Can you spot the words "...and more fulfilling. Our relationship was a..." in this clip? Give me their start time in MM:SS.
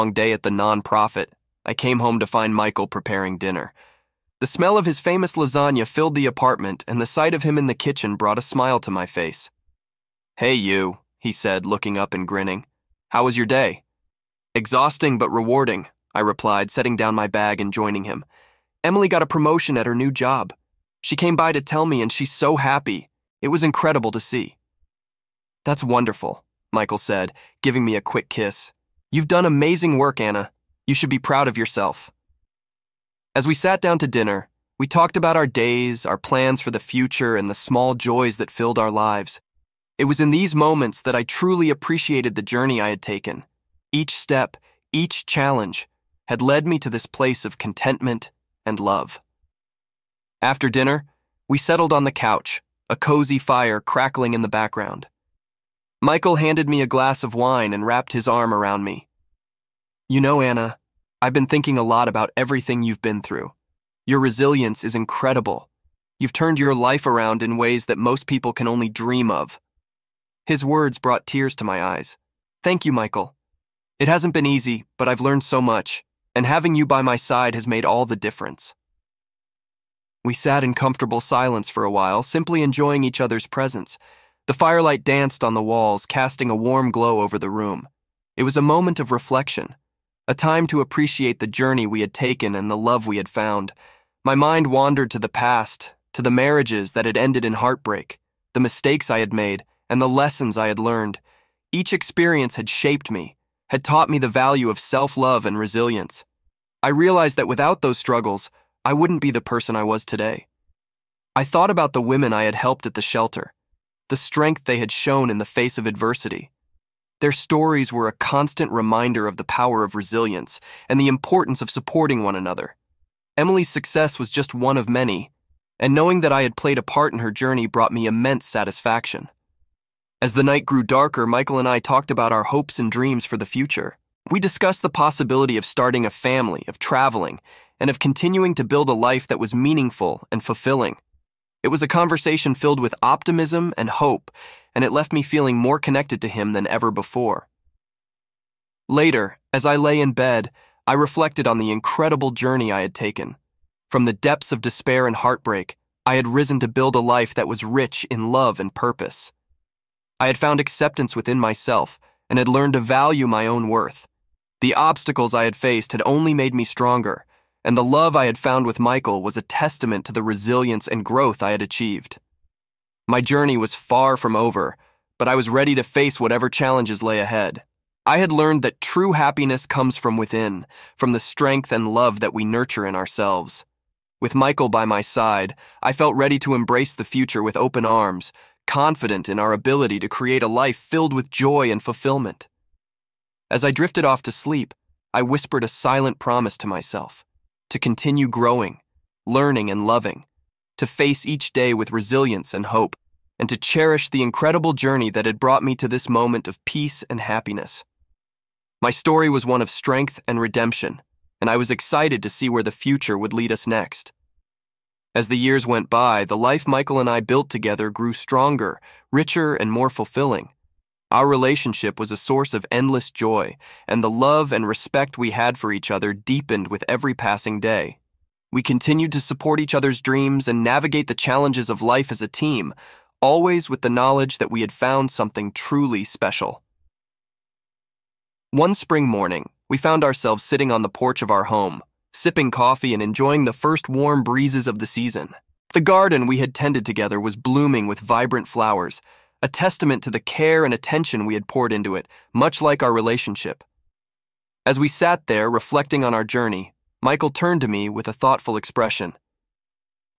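03:39.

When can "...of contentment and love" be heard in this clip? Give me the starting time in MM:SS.
00:47.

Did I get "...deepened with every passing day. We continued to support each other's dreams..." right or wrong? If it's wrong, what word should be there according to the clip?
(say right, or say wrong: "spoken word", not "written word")
right.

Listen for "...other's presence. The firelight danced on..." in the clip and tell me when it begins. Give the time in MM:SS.
01:23.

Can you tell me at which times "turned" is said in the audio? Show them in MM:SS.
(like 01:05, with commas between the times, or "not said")
01:06, 04:17.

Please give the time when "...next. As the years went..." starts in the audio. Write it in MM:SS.
03:33.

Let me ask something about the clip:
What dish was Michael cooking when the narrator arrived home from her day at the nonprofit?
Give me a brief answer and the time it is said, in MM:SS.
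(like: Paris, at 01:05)
lasagna, at 00:05.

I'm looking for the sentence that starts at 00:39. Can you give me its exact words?
It was in these moments that I truly appreciated the journey I had taken.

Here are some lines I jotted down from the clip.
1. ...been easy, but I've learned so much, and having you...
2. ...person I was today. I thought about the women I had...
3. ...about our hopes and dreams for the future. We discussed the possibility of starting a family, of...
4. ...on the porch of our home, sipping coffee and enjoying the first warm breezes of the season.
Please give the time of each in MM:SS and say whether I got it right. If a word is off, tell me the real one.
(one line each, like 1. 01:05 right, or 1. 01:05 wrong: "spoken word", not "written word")
1. 01:14 right
2. 01:49 right
3. 02:12 right
4. 04:00 right.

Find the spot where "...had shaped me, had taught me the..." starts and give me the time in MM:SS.
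01:42.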